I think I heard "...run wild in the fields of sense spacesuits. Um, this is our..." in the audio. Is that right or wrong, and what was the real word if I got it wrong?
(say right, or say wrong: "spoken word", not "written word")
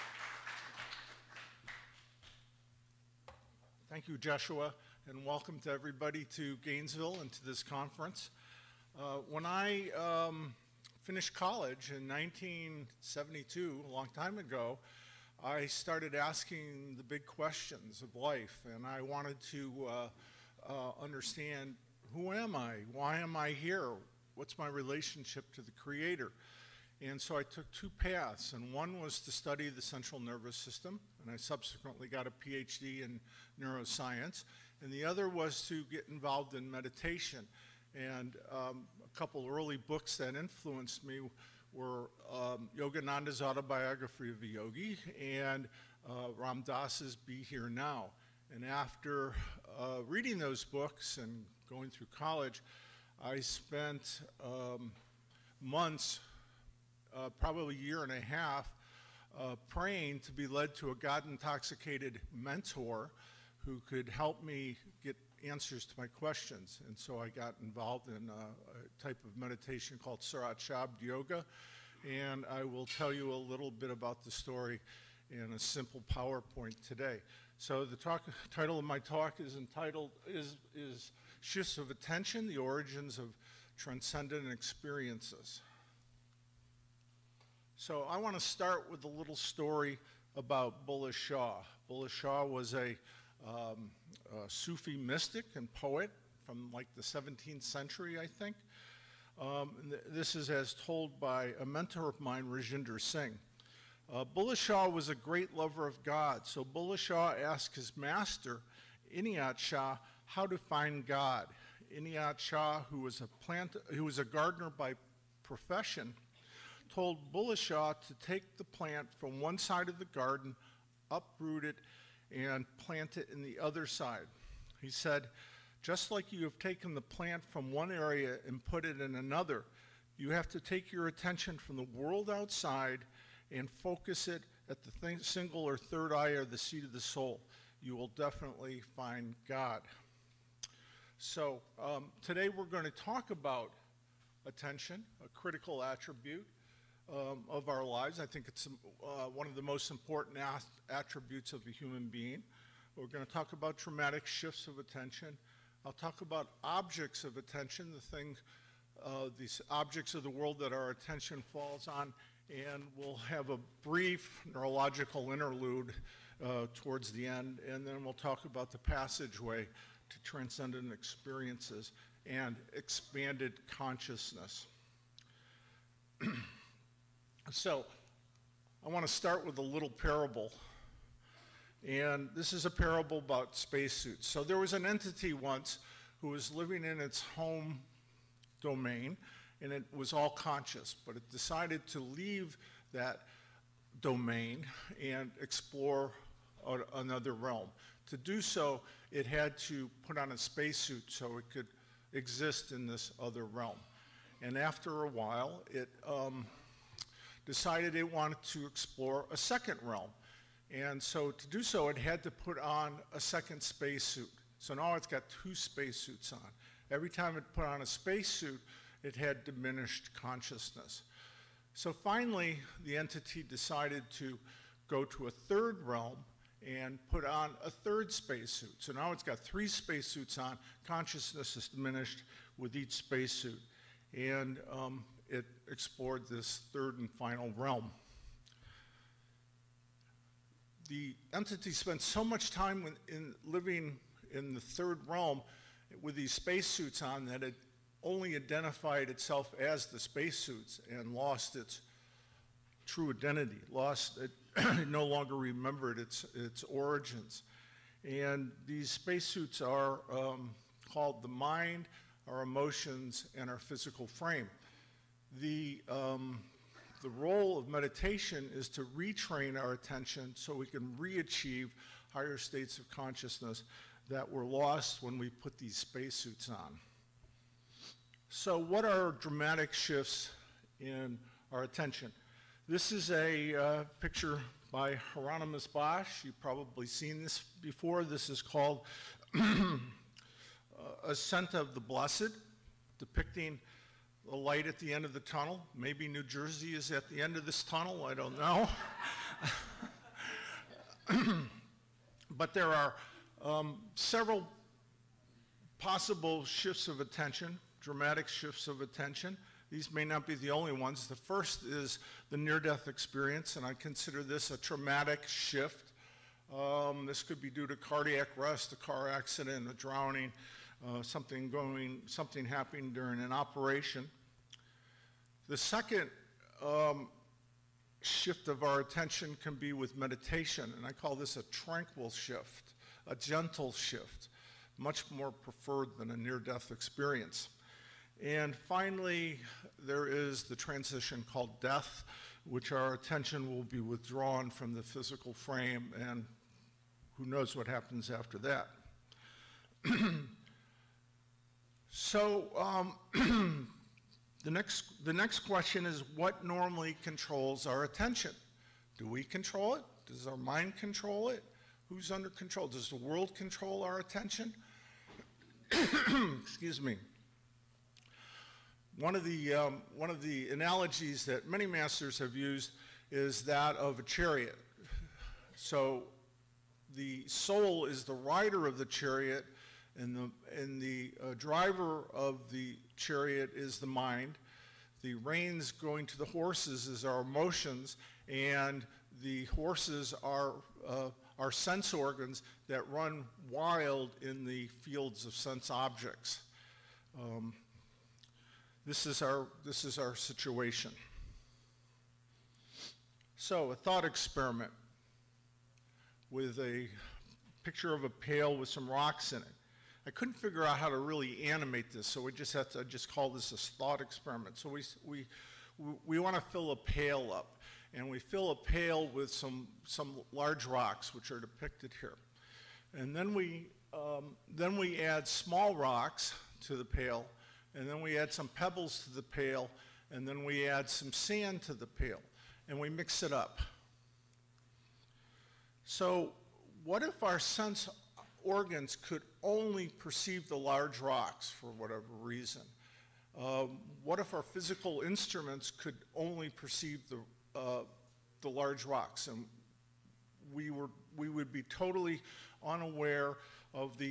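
wrong: "objects", not "spacesuits".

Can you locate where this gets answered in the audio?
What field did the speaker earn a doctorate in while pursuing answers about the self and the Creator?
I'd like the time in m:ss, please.
0:33.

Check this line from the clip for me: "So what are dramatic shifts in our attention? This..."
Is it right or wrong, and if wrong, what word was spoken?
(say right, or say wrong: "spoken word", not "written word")
right.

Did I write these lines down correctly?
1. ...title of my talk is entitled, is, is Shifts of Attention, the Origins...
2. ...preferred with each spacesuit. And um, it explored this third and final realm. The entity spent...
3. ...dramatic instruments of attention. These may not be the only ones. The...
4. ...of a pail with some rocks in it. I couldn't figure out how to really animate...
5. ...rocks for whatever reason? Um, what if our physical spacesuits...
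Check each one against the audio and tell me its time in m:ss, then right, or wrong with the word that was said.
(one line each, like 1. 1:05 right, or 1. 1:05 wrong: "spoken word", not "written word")
1. 1:18 right
2. 3:51 wrong: "diminished", not "preferred"
3. 5:07 wrong: "shifts", not "instruments"
4. 6:47 right
5. 7:20 wrong: "instruments", not "spacesuits".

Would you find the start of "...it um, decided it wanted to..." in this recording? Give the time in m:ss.
3:25.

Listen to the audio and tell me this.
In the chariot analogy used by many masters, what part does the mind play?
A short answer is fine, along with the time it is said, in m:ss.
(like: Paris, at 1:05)
driver, at 6:21.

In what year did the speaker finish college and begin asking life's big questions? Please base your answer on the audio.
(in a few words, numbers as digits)
1972.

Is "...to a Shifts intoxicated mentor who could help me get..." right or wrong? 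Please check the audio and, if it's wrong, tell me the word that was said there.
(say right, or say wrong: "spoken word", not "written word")
wrong: "God", not "Shifts".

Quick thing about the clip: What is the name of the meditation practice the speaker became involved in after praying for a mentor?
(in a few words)
Surat Shabd Yoga.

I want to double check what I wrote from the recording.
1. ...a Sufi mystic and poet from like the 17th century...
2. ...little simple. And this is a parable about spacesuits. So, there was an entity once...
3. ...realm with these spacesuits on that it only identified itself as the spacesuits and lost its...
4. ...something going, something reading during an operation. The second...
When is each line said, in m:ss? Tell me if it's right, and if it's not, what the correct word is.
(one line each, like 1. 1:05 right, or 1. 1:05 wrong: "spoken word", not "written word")
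1. 1:34 right
2. 2:59 wrong: "parable", not "simple"
3. 4:05 right
4. 5:21 wrong: "happening", not "reading".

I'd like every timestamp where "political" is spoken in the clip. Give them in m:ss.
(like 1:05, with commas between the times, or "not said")
not said.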